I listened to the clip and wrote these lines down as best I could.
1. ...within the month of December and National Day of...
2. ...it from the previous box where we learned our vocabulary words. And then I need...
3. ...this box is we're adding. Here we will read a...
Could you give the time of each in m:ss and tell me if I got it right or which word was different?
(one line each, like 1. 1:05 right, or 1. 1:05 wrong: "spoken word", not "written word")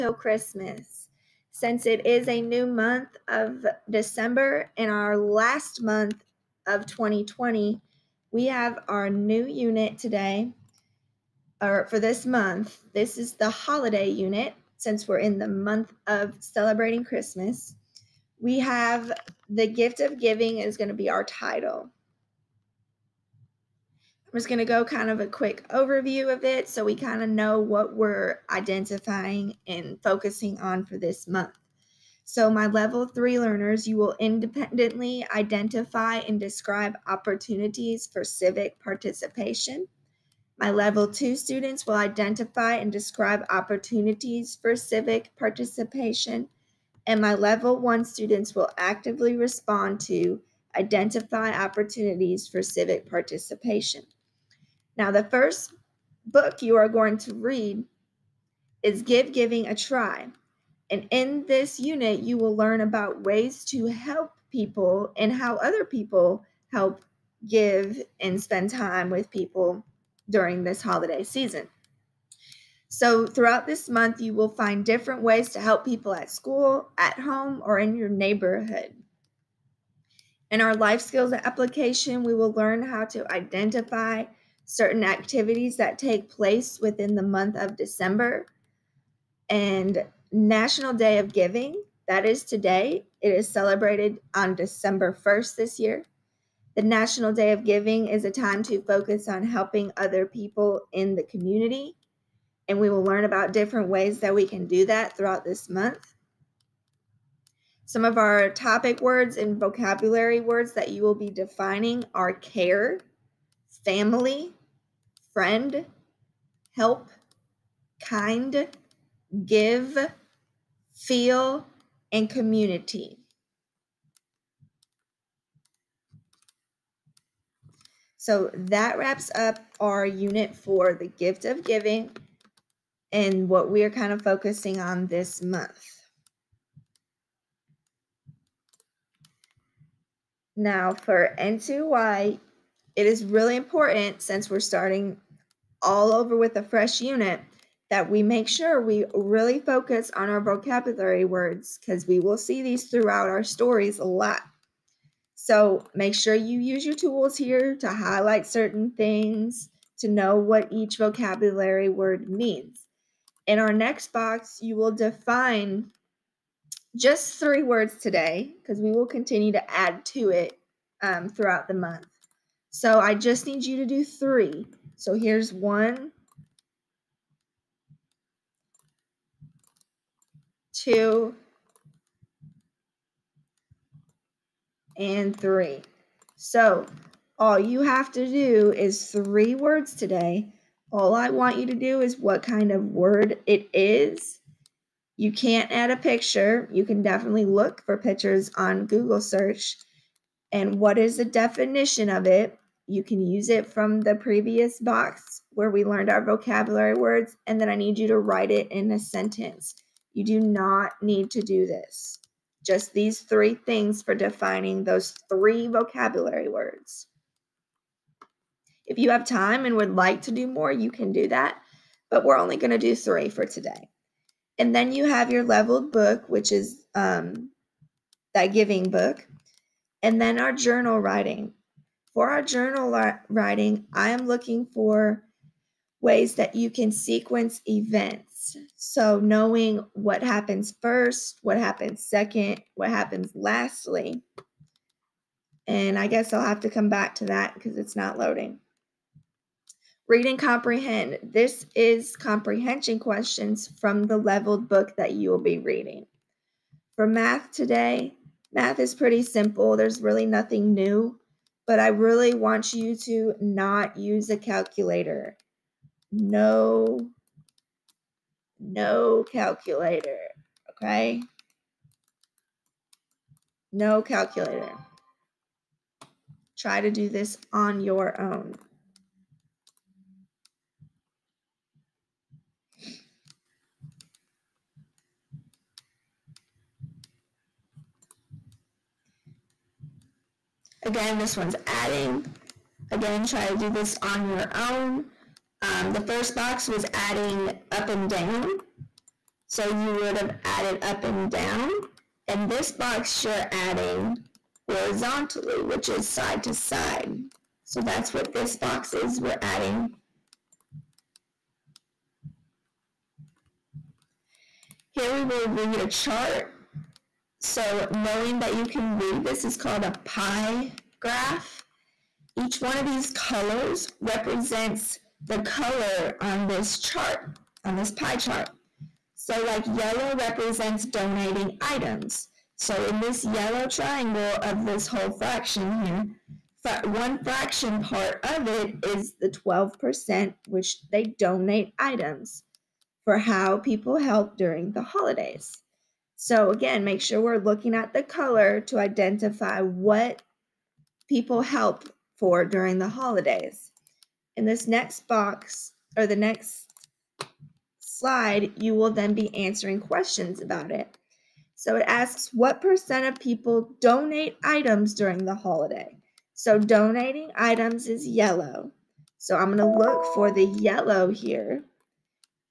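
1. 1:26 right
2. 3:23 right
3. 5:08 right.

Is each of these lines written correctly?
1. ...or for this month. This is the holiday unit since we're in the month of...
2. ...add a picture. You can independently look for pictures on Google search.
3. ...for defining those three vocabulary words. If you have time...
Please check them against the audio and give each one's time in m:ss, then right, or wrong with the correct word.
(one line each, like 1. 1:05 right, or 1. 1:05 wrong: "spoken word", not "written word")
1. 0:11 right
2. 3:15 wrong: "definitely", not "independently"
3. 3:34 right.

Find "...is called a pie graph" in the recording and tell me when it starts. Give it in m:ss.
5:19.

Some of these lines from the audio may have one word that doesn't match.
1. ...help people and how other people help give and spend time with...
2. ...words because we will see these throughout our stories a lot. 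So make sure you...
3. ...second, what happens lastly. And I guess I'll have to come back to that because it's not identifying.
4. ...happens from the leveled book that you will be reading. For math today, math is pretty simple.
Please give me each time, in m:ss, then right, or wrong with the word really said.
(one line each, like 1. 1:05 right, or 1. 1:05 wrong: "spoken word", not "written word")
1. 1:03 right
2. 2:31 right
3. 4:02 wrong: "loading", not "identifying"
4. 4:12 wrong: "questions", not "happens".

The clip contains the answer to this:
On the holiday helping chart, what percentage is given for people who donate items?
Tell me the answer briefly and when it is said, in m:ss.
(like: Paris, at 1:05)
12%, at 5:39.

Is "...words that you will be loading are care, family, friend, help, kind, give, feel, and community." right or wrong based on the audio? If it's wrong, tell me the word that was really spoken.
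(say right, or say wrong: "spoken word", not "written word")
wrong: "defining", not "loading".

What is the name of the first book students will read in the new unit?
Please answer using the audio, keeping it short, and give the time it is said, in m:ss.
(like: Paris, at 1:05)
Give Giving a Try, at 0:58.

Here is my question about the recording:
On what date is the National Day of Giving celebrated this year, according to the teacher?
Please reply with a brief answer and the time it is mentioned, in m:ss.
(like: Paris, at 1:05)
December 1st, at 1:34.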